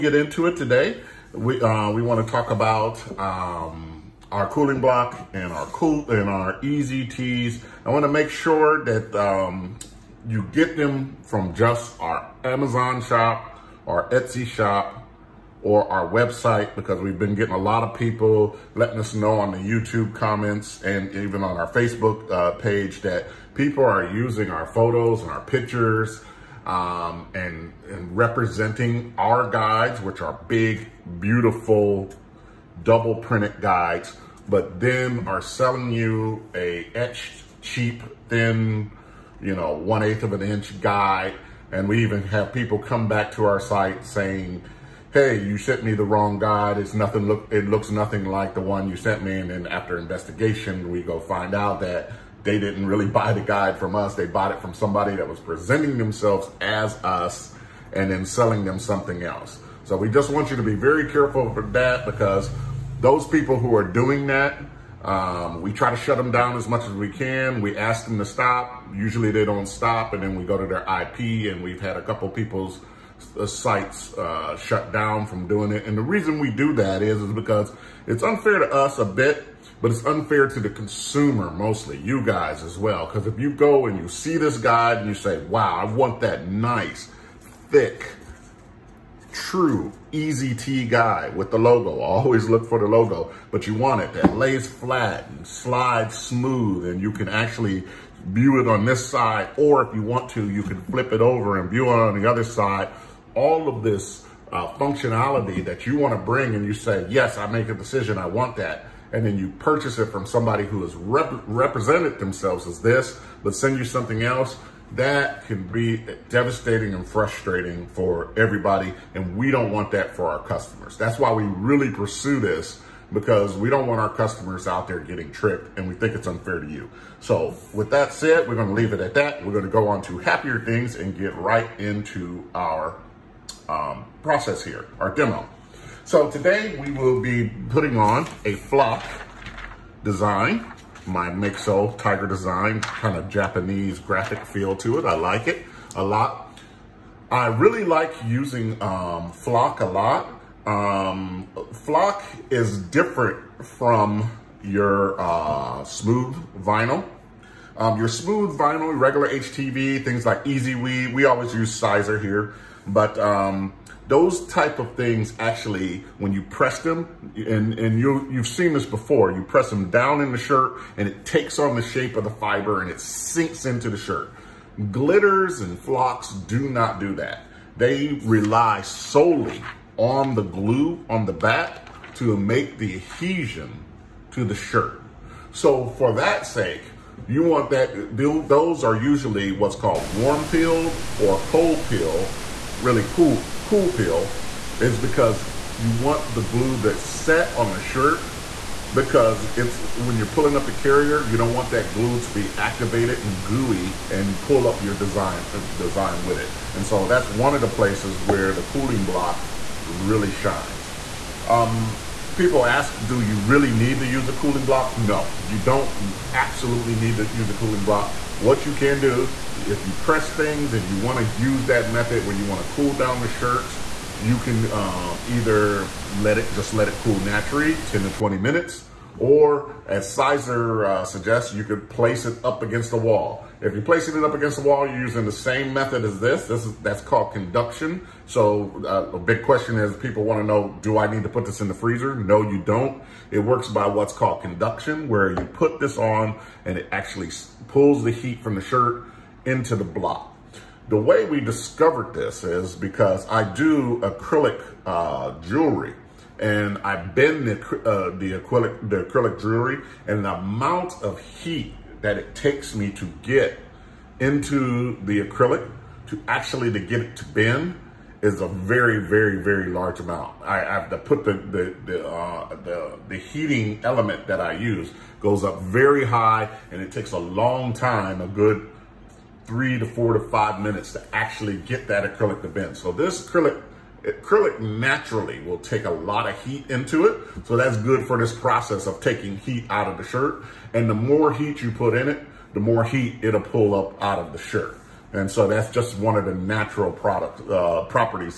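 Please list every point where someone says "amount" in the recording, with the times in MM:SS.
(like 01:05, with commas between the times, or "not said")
04:20, 04:29.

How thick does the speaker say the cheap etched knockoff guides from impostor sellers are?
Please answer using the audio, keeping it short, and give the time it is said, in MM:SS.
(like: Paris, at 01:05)
1/8 of an inch, at 00:39.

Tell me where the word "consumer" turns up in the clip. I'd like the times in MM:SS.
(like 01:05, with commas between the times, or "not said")
01:20.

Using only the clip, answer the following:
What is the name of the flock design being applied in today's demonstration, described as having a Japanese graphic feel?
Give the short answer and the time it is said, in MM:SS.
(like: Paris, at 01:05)
Makeso Tiger, at 02:21.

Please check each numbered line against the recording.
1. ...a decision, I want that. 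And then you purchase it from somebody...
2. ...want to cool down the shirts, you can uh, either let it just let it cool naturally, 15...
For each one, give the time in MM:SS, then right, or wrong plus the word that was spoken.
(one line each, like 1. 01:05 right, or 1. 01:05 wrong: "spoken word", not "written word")
1. 01:47 right
2. 03:42 wrong: "10", not "15".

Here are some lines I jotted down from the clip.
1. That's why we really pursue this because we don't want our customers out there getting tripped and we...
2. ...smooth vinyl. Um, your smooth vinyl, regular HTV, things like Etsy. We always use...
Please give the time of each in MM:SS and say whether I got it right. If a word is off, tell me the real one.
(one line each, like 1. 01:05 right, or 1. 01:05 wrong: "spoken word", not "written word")
1. 02:00 right
2. 02:35 wrong: "EasyWeed", not "Etsy".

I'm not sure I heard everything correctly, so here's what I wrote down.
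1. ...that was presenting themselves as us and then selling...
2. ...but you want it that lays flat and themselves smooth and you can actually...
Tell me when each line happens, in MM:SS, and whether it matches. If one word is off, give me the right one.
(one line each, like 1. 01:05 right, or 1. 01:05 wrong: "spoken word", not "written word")
1. 00:55 right
2. 01:33 wrong: "slides", not "themselves".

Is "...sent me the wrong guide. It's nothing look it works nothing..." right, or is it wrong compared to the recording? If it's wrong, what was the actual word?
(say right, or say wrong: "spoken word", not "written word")
wrong: "looks", not "works".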